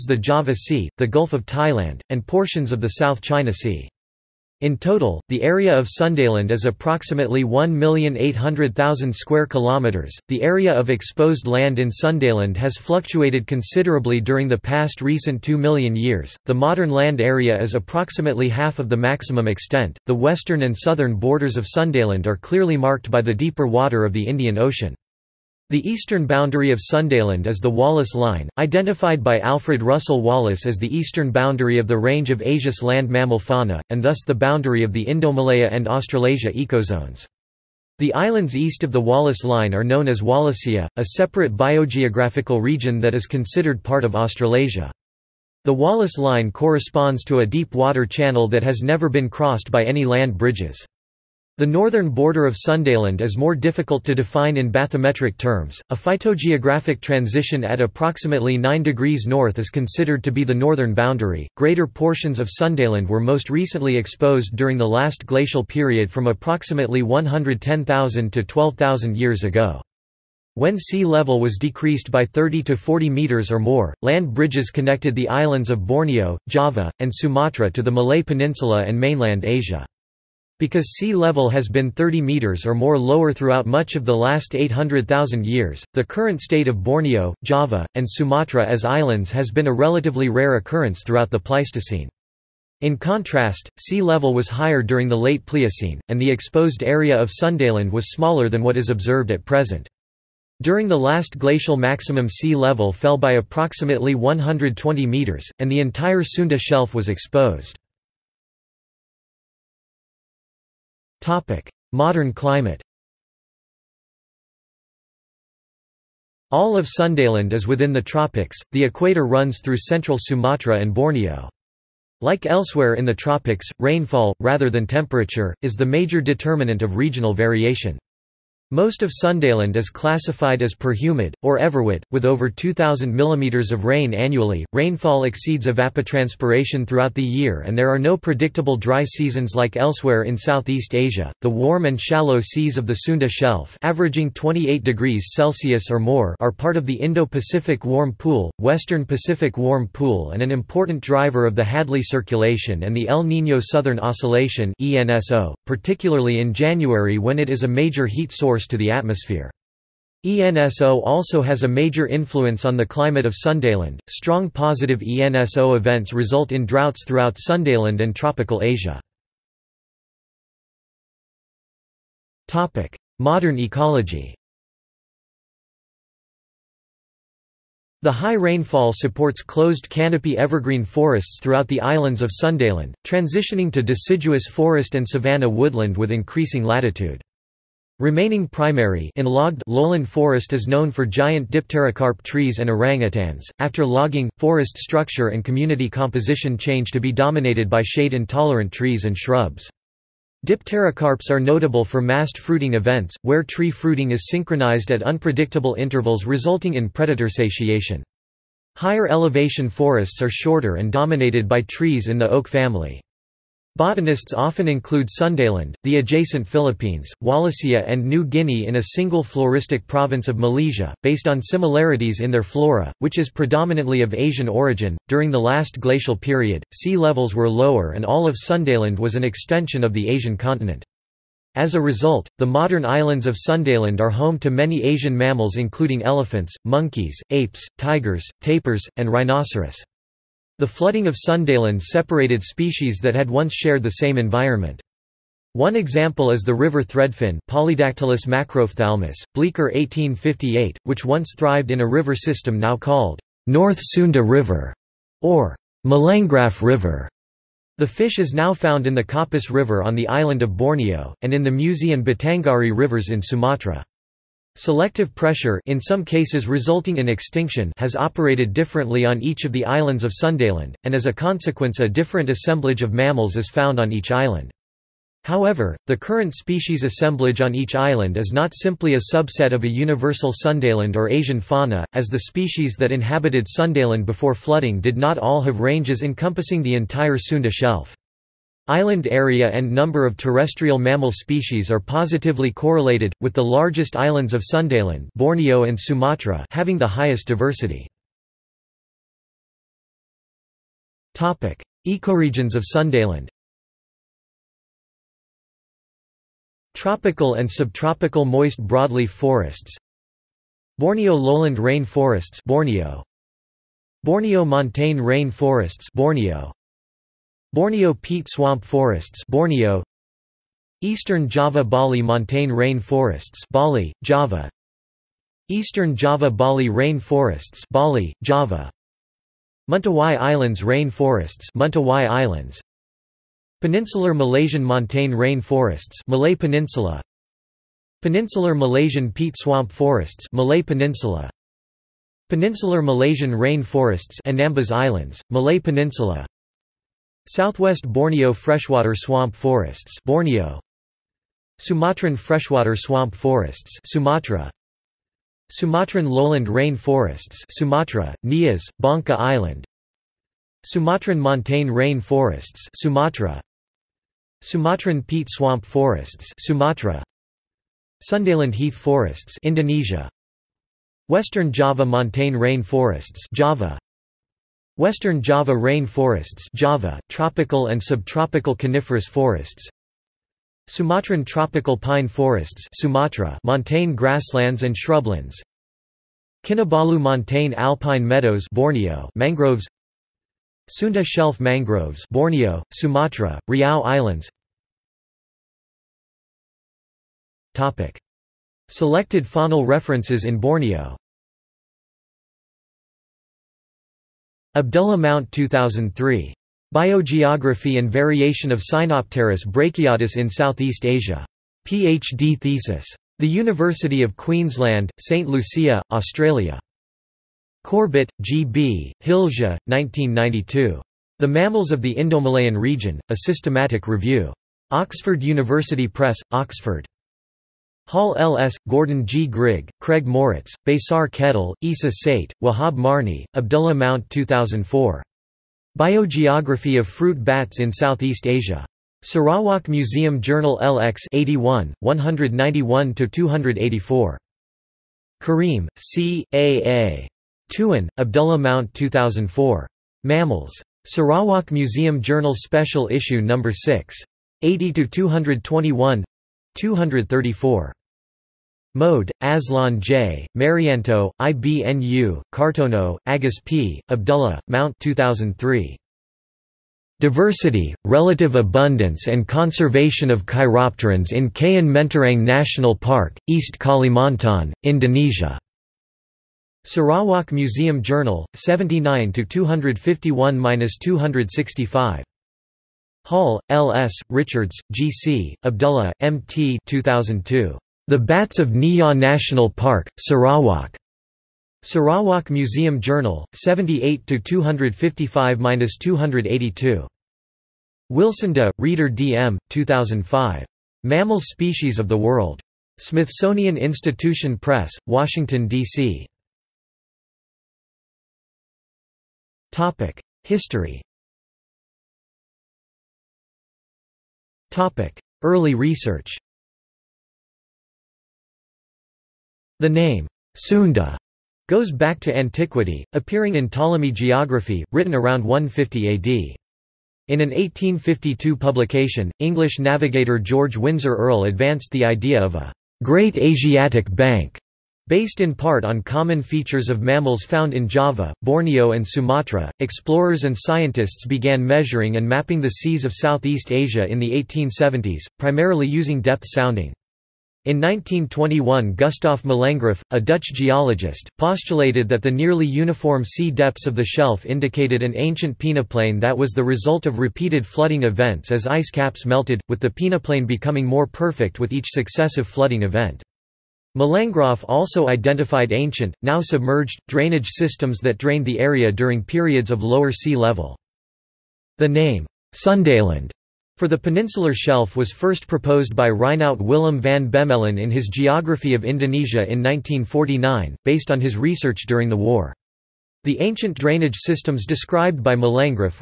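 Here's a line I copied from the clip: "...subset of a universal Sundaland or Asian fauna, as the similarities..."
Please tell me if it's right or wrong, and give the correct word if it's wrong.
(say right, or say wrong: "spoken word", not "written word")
wrong: "species", not "similarities".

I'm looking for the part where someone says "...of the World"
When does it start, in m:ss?
8:21.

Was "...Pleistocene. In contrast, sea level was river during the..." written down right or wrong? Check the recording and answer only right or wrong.
wrong.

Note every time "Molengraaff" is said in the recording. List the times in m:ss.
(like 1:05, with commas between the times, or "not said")
4:15, 9:09, 9:23, 9:45.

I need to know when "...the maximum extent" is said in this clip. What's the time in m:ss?
0:18.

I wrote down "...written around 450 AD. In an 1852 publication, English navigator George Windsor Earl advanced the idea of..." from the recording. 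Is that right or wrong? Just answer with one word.
wrong.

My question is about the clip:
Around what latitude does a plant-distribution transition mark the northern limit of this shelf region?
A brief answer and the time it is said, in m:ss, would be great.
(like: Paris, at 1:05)
9 degrees north, at 0:58.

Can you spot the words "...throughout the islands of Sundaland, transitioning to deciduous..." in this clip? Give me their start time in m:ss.
3:01.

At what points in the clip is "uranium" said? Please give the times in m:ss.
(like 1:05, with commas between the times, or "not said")
not said.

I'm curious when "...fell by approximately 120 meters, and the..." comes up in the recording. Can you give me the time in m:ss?
1:42.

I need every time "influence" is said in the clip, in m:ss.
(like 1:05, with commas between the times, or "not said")
2:42.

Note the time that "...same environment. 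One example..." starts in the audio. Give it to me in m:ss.
4:03.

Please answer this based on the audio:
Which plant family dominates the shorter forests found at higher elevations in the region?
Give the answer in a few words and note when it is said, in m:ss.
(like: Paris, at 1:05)
oak family, at 3:32.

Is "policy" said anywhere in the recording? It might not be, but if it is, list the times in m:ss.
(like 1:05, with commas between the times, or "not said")
not said.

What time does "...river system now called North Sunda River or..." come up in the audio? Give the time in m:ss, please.
4:11.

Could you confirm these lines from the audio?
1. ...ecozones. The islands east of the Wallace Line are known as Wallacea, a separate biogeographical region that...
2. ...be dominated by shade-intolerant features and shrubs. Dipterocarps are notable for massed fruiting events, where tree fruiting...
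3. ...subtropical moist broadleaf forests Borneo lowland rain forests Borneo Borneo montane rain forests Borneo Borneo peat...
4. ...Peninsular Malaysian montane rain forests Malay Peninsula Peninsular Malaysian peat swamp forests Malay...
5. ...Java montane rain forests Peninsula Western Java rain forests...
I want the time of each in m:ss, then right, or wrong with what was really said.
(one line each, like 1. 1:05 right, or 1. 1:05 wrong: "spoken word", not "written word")
1. 0:36 right
2. 3:17 wrong: "trees", not "features"
3. 5:07 right
4. 5:33 right
5. 6:11 wrong: "Java", not "Peninsula".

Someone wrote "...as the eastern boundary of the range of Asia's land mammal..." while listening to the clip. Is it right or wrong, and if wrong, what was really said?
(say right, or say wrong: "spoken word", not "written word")
right.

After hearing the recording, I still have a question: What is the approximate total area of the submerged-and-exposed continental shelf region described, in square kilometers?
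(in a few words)
1,800,000 square kilometers.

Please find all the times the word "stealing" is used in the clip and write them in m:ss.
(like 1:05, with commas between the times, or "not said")
not said.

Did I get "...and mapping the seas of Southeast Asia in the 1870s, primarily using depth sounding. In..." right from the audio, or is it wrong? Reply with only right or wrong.
right.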